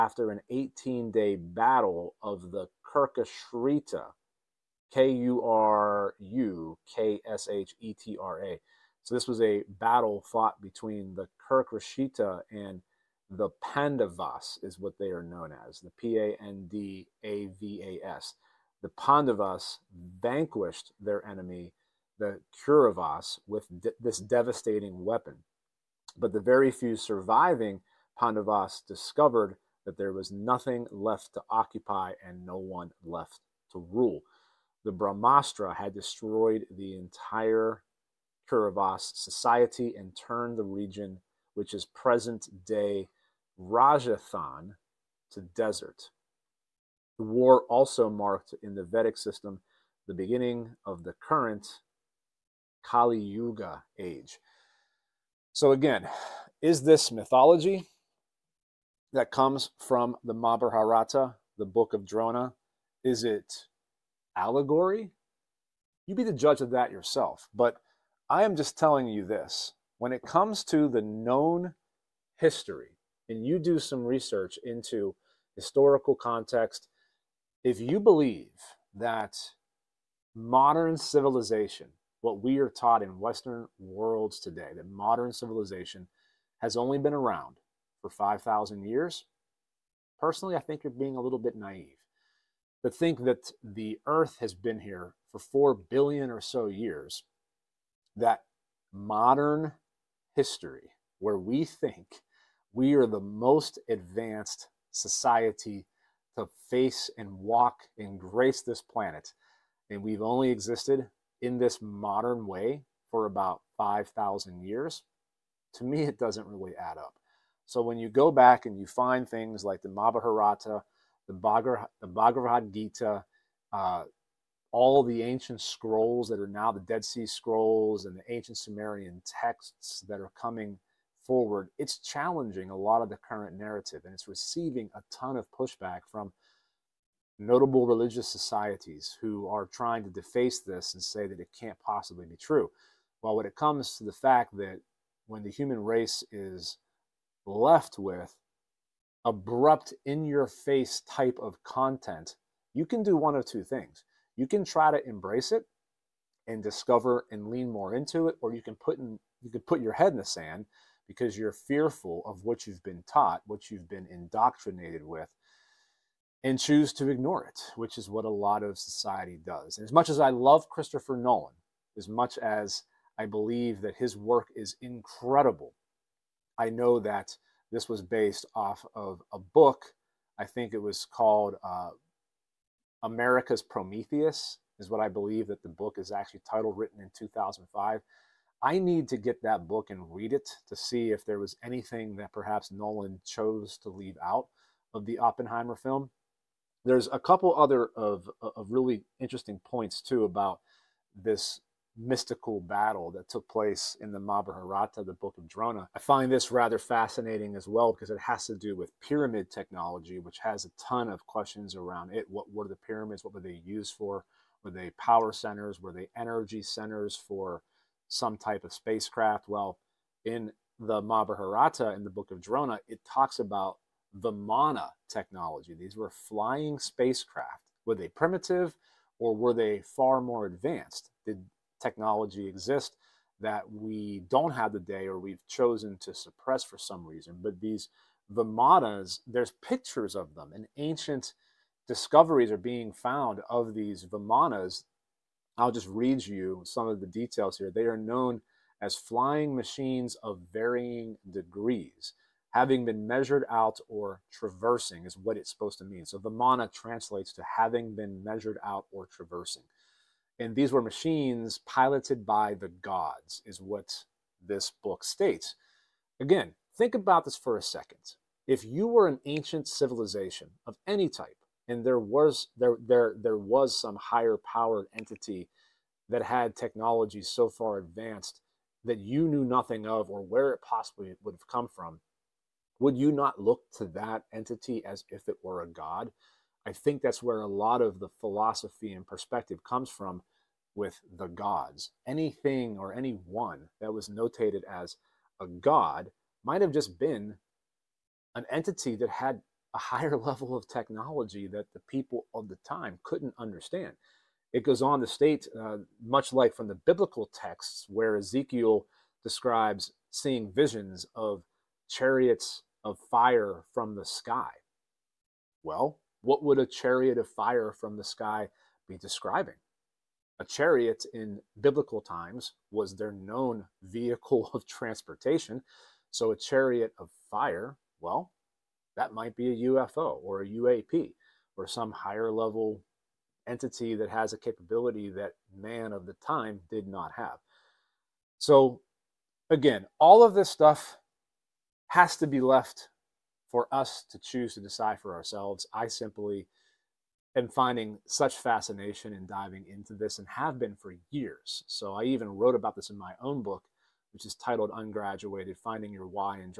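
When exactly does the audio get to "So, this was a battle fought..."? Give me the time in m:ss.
0:09.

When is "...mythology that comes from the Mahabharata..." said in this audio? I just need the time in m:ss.
0:57.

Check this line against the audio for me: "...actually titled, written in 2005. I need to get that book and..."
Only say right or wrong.
right.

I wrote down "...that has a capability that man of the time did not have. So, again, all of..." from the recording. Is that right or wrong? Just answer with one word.
right.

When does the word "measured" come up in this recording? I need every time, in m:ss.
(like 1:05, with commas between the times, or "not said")
4:13, 4:18.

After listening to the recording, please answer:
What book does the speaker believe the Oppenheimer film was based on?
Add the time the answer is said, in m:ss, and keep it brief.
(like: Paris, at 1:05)
America's Prometheus, at 3:03.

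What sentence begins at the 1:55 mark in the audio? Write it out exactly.
To me, it doesn't really add up.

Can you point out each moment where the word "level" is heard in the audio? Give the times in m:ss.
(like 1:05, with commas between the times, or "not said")
5:00, 5:32.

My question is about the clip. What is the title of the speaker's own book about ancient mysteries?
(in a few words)
Ungraduated.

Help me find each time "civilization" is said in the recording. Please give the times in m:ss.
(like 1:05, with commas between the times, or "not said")
1:20, 1:25, 4:29.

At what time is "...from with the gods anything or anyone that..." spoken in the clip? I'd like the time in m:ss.
4:49.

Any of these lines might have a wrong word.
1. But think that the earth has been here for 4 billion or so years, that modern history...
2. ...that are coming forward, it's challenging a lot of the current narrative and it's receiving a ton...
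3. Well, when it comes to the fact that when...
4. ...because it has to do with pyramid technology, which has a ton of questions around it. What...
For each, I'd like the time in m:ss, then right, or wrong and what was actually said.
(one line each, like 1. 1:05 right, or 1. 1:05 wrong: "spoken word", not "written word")
1. 1:32 right
2. 2:10 right
3. 2:23 right
4. 3:27 right.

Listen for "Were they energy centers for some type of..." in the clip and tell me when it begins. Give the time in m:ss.
3:35.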